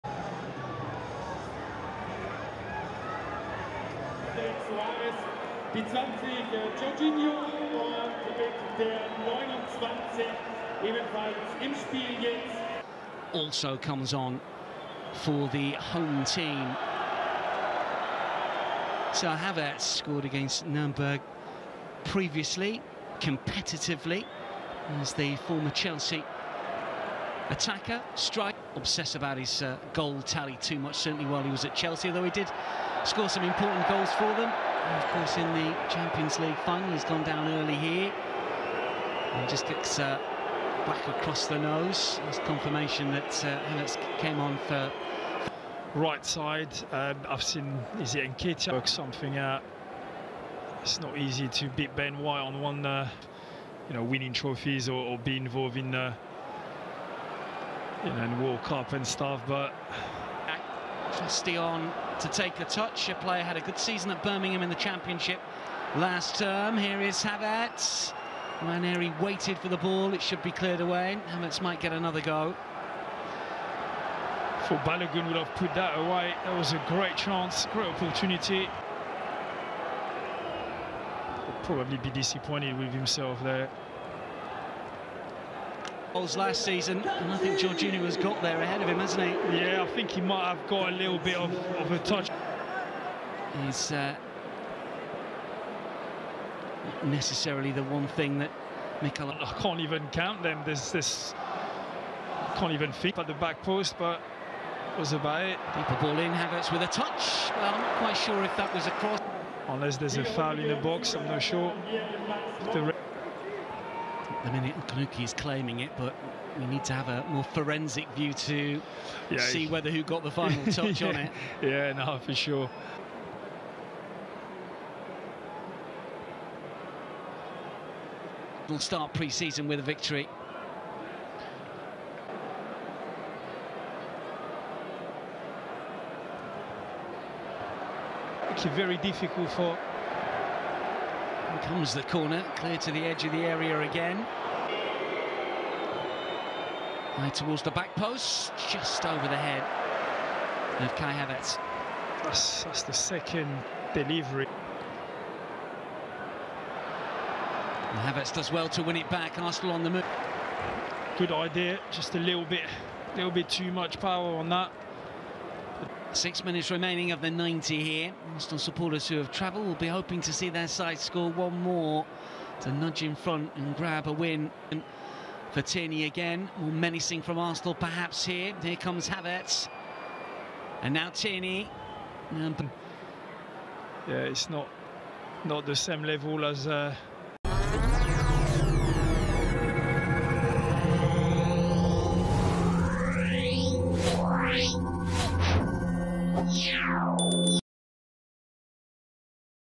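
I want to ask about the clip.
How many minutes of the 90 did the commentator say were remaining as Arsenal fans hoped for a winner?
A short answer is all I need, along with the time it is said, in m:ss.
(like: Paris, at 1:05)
6, at 2:46.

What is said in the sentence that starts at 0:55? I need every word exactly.
Uh, and then walk up and stuff, but...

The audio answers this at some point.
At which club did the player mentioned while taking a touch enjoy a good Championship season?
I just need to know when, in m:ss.
1:04.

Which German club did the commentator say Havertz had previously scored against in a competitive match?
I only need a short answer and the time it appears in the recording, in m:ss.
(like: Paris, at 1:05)
Nuremberg, at 0:20.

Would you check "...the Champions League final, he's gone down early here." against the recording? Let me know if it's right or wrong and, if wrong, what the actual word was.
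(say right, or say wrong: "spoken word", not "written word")
right.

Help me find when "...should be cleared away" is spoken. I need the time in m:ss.
1:10.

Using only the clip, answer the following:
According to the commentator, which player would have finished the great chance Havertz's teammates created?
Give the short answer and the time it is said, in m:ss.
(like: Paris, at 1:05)
Balogun, at 1:14.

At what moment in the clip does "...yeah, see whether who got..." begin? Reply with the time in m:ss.
1:59.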